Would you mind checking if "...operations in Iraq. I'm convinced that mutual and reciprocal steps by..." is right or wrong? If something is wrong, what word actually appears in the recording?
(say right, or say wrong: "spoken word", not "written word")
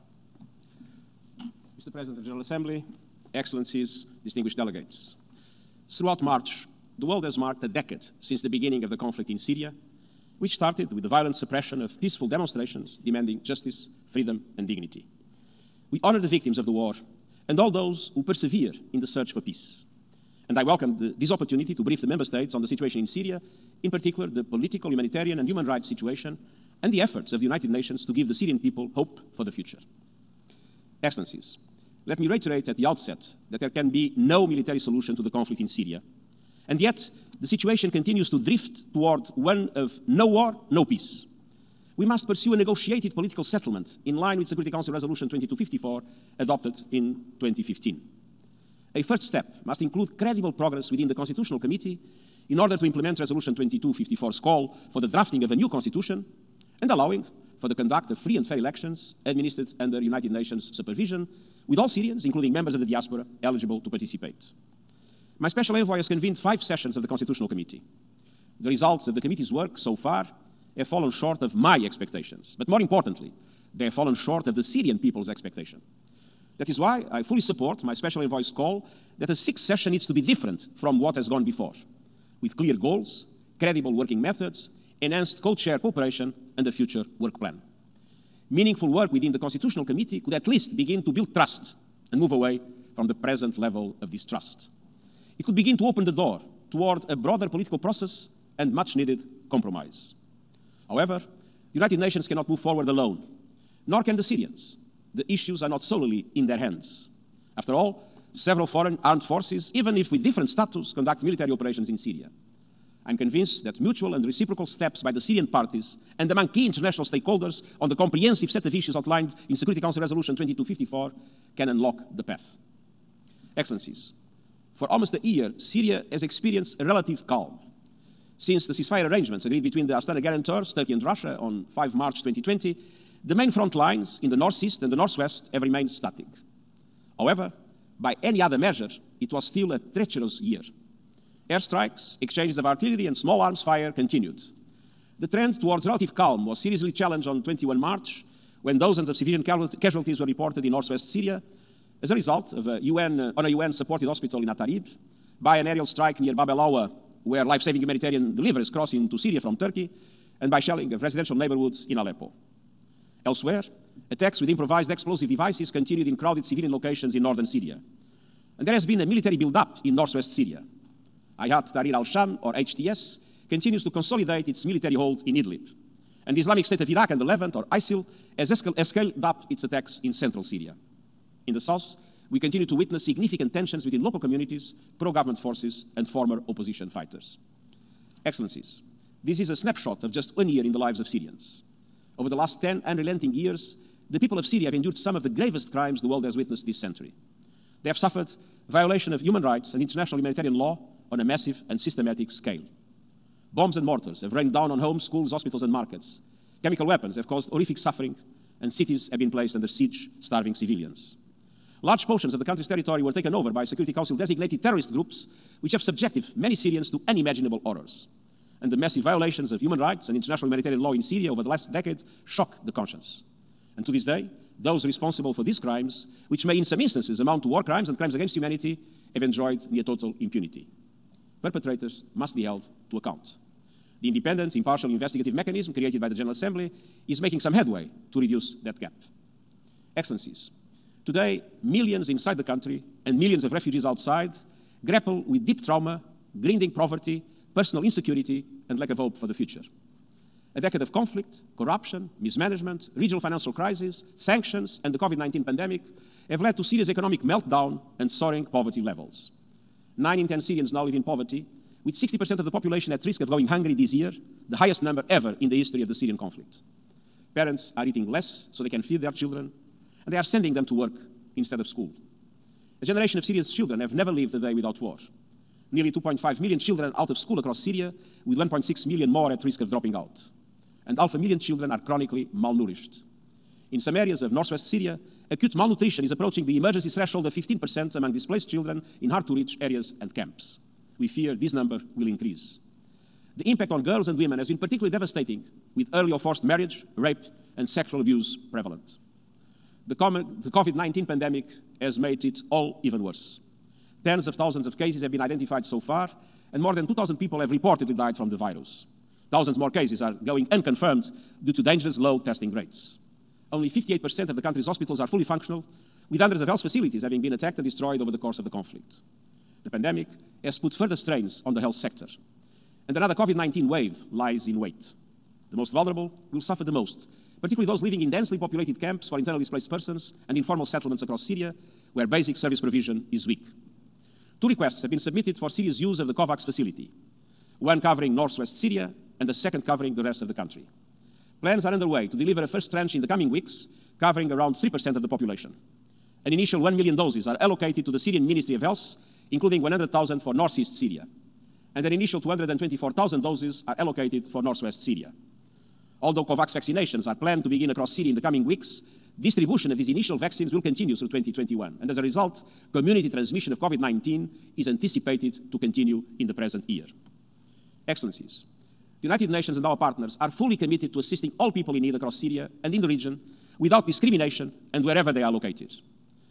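wrong: "Syria", not "Iraq".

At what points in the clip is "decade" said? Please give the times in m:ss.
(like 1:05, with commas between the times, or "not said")
0:07, 3:41, 4:10.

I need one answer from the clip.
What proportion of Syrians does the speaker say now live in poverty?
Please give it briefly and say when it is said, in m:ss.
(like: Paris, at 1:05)
9 in 10, at 4:19.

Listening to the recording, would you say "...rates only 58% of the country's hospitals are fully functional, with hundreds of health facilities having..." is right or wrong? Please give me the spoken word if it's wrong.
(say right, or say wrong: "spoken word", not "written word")
right.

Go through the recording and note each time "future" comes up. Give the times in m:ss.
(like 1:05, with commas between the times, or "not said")
0:29, 1:26, 4:09.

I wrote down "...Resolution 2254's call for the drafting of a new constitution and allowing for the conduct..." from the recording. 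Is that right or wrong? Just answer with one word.
right.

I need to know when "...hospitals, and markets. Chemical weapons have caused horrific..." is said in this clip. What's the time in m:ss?
3:25.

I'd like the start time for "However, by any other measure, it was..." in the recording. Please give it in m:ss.
2:17.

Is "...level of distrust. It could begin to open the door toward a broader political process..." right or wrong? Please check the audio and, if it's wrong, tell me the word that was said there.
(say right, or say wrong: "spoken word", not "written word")
right.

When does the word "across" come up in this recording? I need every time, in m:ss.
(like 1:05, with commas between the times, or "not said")
4:37, 5:31, 5:57, 6:11.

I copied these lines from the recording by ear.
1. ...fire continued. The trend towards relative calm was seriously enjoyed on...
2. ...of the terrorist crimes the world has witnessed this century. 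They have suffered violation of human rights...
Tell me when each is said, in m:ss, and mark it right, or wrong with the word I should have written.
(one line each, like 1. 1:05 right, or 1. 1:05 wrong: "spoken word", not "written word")
1. 2:23 wrong: "challenged", not "enjoyed"
2. 3:15 wrong: "gravest", not "terrorist".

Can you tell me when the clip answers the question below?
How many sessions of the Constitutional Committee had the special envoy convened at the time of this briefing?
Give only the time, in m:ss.
1:06.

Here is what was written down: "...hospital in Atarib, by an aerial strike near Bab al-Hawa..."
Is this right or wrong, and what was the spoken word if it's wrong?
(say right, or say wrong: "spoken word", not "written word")
right.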